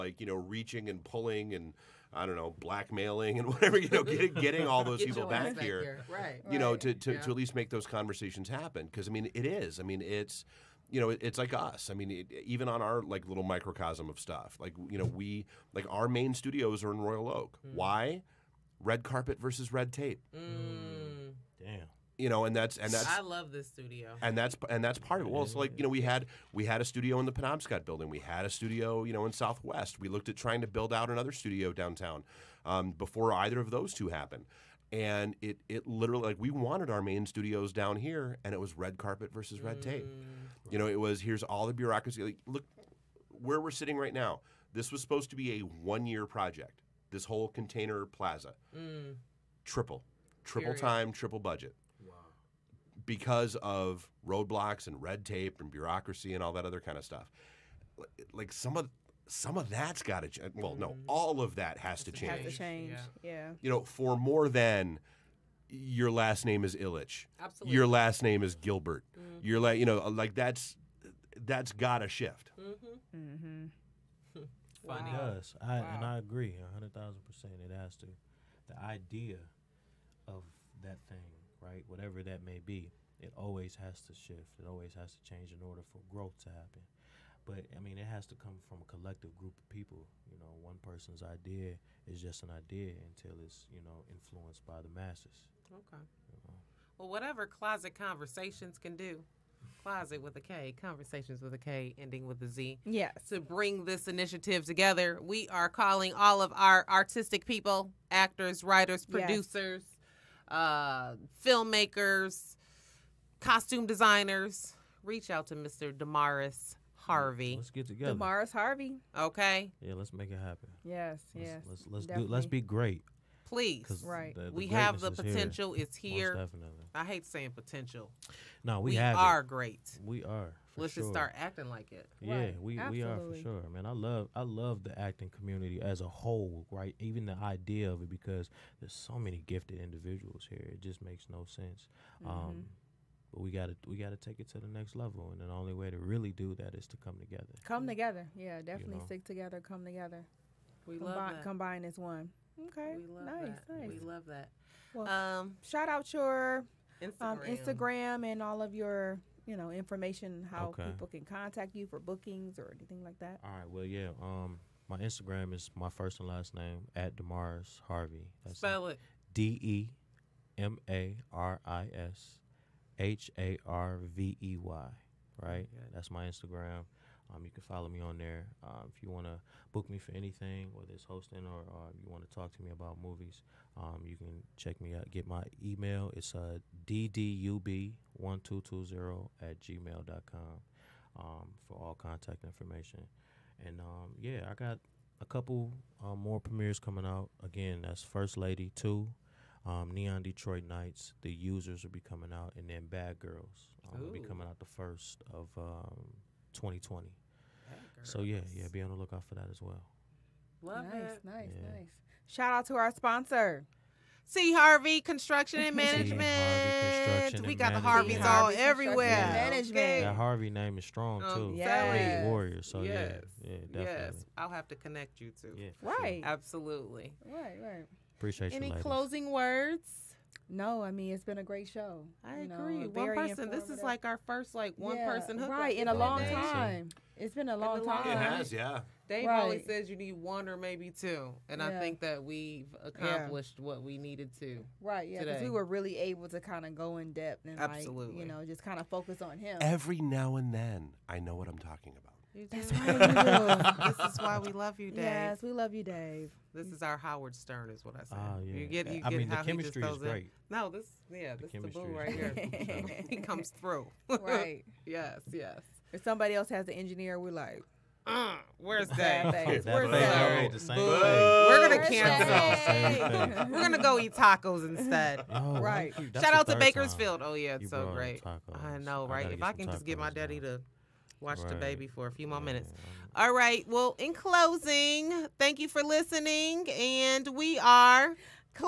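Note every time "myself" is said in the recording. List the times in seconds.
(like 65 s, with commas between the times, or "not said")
not said.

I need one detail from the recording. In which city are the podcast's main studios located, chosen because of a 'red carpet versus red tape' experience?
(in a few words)
Royal Oak.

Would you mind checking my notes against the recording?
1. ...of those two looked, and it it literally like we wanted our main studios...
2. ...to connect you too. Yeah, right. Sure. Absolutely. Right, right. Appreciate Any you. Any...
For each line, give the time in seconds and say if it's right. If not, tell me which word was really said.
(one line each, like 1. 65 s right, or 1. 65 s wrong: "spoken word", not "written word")
1. 33 s wrong: "happened", not "looked"
2. 224 s right.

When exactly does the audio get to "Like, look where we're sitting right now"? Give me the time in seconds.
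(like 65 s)
42 s.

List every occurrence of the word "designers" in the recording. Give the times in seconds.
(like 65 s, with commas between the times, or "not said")
113 s.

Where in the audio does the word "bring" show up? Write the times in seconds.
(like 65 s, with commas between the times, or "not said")
103 s.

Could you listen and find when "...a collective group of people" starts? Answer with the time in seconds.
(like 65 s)
88 s.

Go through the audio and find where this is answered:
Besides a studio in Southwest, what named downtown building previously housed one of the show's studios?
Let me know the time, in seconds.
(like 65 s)
27 s.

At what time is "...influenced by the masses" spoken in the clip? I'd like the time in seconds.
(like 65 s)
94 s.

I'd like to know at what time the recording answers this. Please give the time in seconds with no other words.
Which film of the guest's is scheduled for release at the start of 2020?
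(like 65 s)
202 s.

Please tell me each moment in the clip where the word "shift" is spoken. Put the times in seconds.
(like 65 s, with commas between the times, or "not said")
72 s, 84 s.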